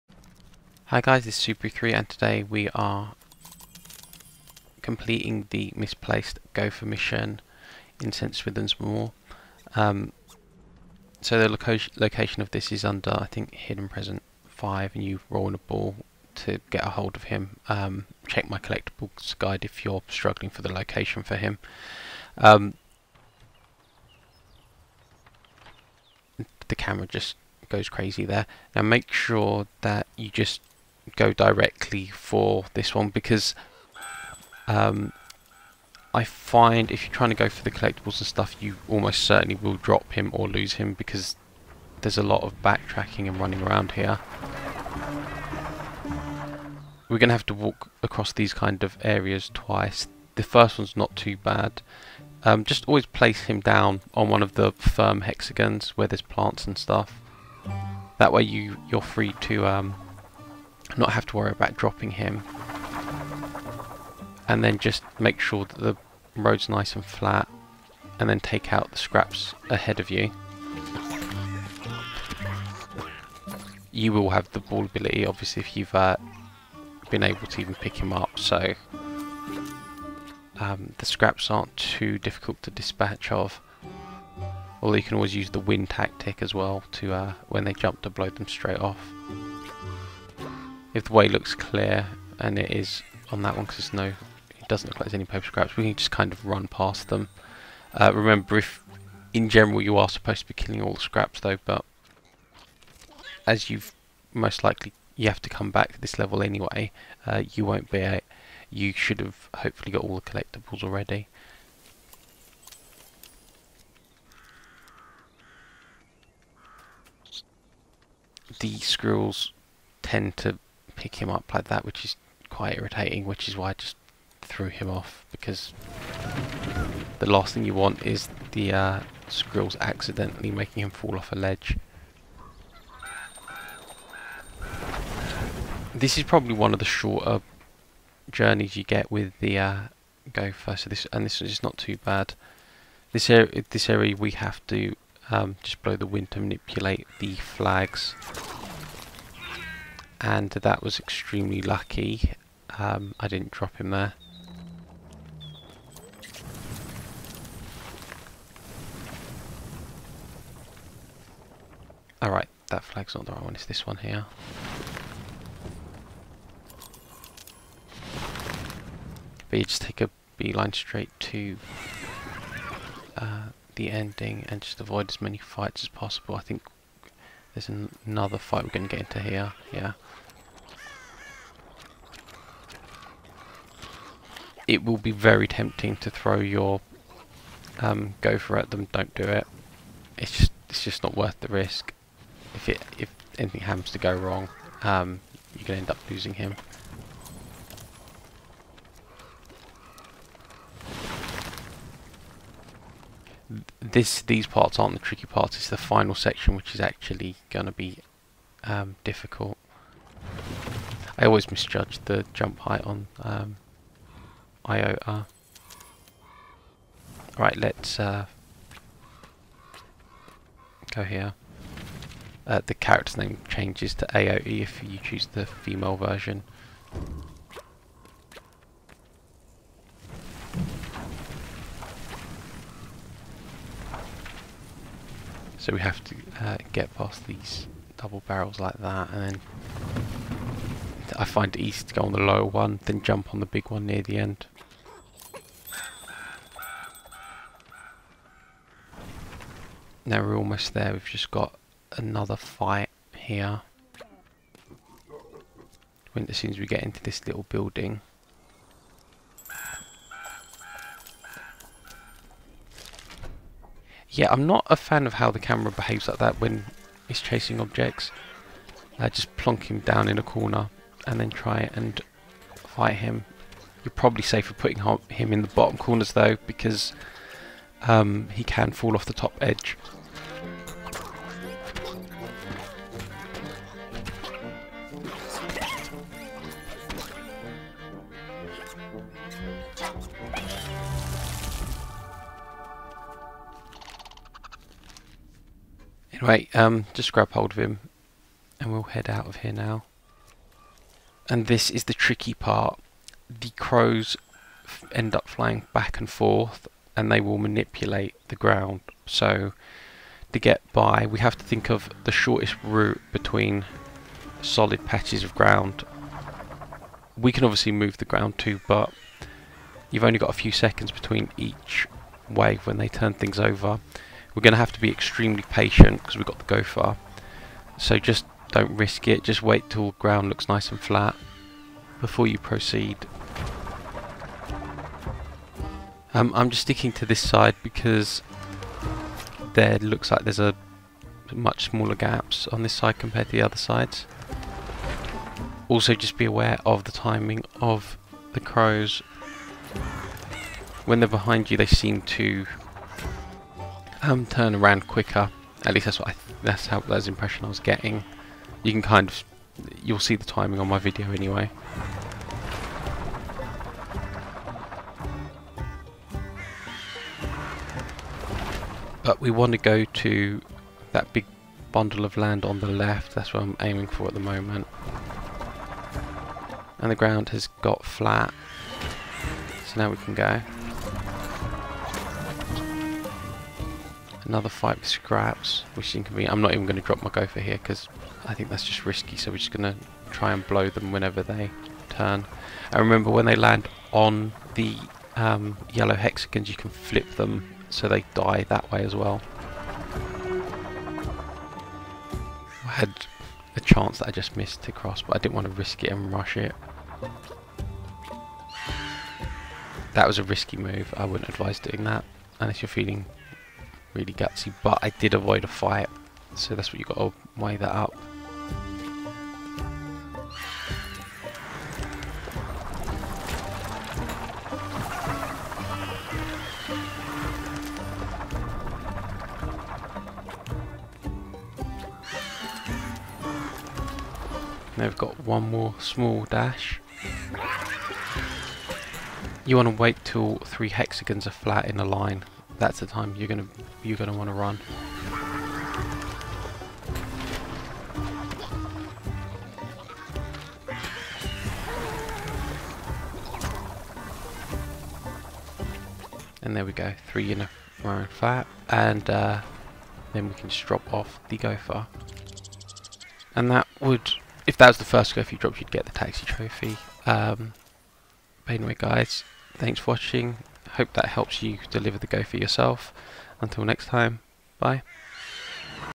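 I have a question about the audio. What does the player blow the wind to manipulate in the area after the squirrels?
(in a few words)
flags.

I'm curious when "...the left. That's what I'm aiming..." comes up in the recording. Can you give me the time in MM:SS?
06:12.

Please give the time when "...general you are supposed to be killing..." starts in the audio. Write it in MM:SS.
01:39.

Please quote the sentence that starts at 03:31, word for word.
I always misjudge the jump height on um, Iota.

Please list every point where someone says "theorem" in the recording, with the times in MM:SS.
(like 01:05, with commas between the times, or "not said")
not said.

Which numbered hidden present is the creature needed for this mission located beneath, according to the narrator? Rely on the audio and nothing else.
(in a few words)
Hidden Present 5.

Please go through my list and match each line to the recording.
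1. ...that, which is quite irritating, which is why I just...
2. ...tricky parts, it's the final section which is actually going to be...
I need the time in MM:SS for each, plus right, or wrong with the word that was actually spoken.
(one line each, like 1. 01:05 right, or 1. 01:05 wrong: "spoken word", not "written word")
1. 02:01 right
2. 03:24 right.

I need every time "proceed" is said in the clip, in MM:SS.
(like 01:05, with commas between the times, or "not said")
05:32.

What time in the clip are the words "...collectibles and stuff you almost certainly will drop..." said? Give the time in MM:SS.
00:37.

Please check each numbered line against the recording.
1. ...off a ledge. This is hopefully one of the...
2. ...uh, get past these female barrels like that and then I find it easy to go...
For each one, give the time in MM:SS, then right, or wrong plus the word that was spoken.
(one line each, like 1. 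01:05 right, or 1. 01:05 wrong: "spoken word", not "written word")
1. 02:11 wrong: "probably", not "hopefully"
2. 03:56 wrong: "double", not "female".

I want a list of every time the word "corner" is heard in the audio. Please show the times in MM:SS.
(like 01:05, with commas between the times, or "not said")
04:30, 04:35.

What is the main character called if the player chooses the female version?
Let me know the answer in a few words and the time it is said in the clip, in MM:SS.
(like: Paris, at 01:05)
Atoi, at 03:44.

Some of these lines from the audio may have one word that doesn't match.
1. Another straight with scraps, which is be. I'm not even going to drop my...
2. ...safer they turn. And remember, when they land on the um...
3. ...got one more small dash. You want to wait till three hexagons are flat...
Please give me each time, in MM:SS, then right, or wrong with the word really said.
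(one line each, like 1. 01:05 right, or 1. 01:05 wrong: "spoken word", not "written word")
1. 06:24 wrong: "fight", not "straight"
2. 06:30 wrong: "whenever", not "safer"
3. 07:14 right.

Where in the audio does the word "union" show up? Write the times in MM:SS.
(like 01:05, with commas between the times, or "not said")
not said.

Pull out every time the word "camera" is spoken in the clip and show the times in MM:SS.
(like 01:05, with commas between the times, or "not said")
00:26, 04:25.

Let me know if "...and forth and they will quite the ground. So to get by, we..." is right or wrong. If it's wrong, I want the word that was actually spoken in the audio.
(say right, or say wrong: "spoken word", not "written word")
wrong: "manipulate", not "quite".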